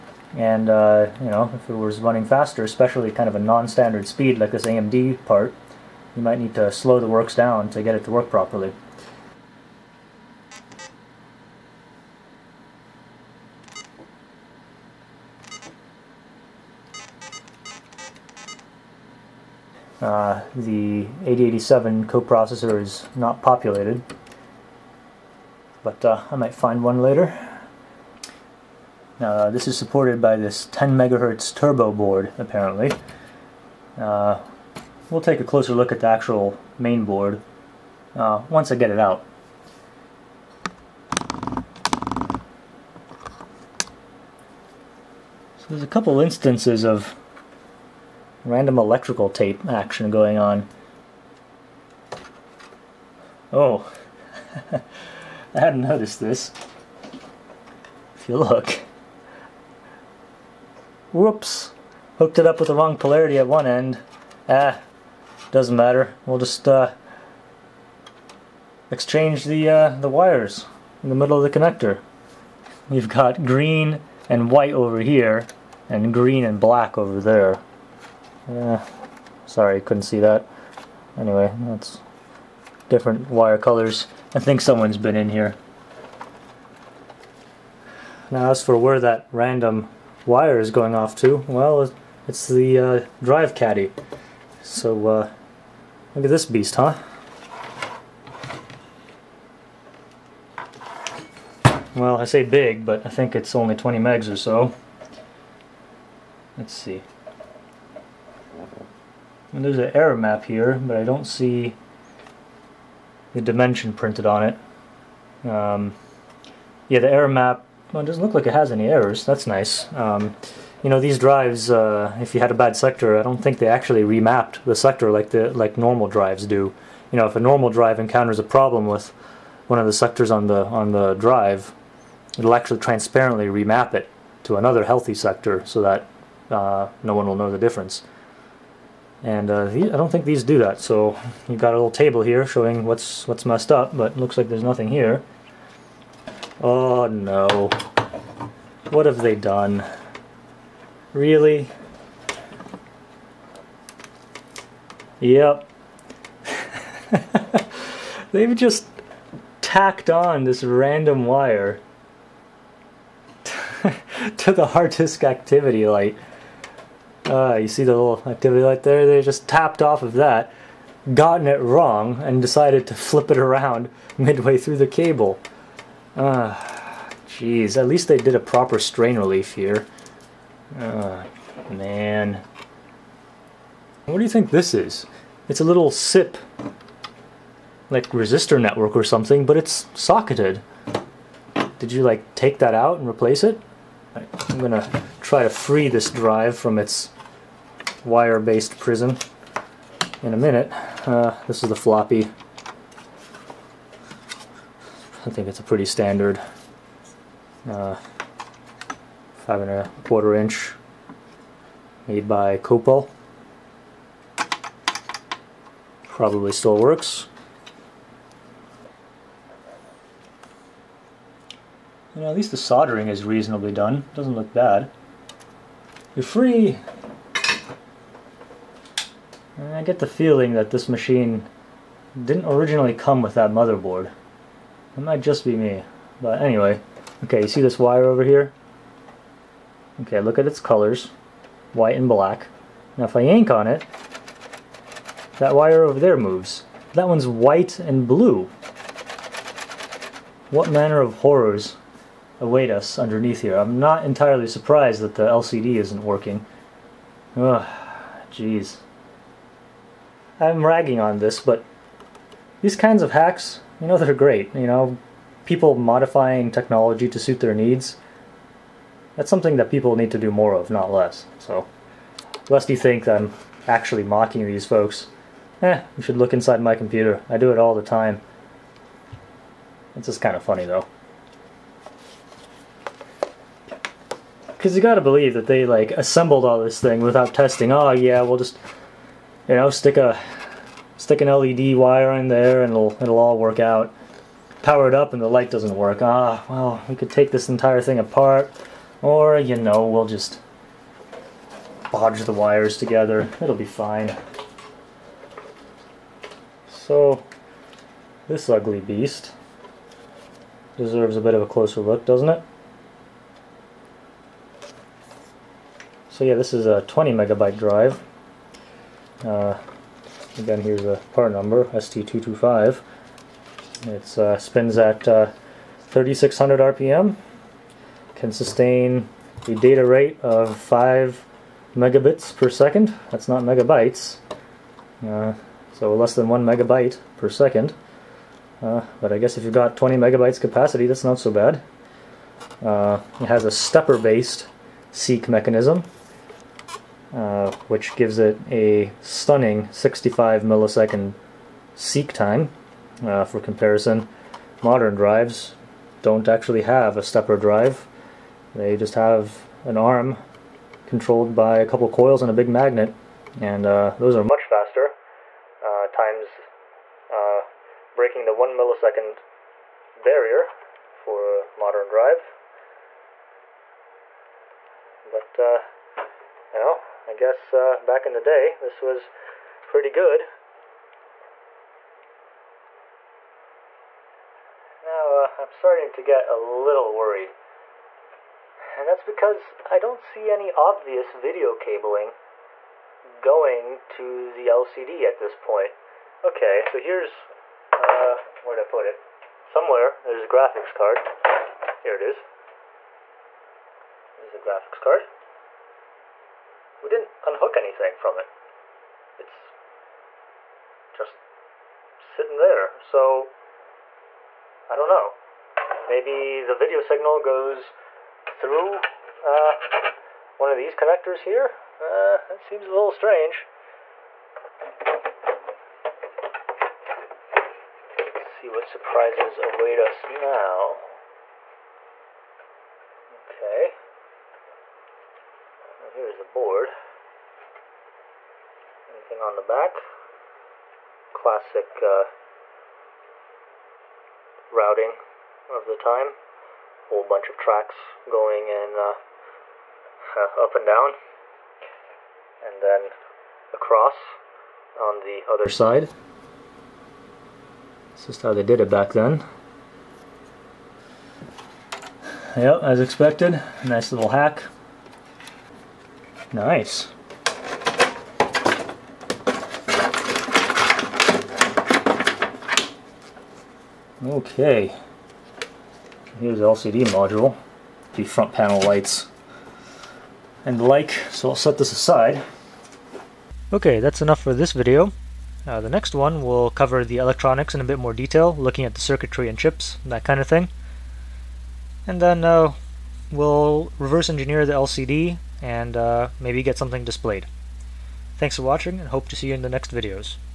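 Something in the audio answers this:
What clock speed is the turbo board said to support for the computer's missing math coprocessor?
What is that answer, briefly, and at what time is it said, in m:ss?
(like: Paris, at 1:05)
10 megahertz, at 0:30.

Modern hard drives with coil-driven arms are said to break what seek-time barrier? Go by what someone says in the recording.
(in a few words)
1 millisecond.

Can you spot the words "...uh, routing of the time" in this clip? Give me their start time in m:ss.
7:21.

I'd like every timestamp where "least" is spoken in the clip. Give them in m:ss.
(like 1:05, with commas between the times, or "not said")
2:57, 3:42.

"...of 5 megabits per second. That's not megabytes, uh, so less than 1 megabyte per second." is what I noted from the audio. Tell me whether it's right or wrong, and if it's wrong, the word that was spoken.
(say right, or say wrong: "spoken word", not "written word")
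right.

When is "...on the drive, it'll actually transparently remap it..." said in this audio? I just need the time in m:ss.
2:10.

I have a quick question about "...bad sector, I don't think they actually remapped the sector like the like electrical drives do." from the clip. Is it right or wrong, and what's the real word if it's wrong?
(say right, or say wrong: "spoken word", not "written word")
wrong: "normal", not "electrical".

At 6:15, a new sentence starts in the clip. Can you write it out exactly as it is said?
But you know, I guess uh, back in the day this was pretty good.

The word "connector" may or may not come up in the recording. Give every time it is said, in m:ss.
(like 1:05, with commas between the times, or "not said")
1:11, 7:00.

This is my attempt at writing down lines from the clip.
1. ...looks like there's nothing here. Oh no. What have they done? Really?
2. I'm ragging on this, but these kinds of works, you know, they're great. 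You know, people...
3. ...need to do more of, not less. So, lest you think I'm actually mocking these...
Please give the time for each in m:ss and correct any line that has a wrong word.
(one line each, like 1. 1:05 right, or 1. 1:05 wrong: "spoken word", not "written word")
1. 2:24 right
2. 4:20 wrong: "hacks", not "works"
3. 4:29 right.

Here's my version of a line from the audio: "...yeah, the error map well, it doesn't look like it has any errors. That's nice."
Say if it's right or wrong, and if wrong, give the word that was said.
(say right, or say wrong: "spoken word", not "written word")
right.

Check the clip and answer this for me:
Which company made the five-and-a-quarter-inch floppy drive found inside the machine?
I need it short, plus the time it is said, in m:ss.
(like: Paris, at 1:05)
Copal, at 3:32.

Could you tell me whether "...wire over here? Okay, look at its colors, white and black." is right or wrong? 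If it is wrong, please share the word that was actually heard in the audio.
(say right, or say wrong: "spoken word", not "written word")
right.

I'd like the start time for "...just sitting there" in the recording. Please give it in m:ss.
6:50.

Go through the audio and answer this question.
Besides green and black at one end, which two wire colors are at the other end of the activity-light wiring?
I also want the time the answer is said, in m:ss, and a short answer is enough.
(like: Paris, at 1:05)
green and white, at 1:13.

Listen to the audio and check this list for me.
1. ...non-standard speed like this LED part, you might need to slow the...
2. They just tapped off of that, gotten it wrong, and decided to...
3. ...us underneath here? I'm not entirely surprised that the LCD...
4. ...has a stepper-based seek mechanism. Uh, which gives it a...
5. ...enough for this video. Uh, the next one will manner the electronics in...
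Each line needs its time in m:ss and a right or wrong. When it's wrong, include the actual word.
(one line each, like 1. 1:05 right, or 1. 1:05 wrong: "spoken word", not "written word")
1. 0:03 wrong: "AMD", not "LED"
2. 2:49 right
3. 4:12 right
4. 5:43 right
5. 8:04 wrong: "cover", not "manner".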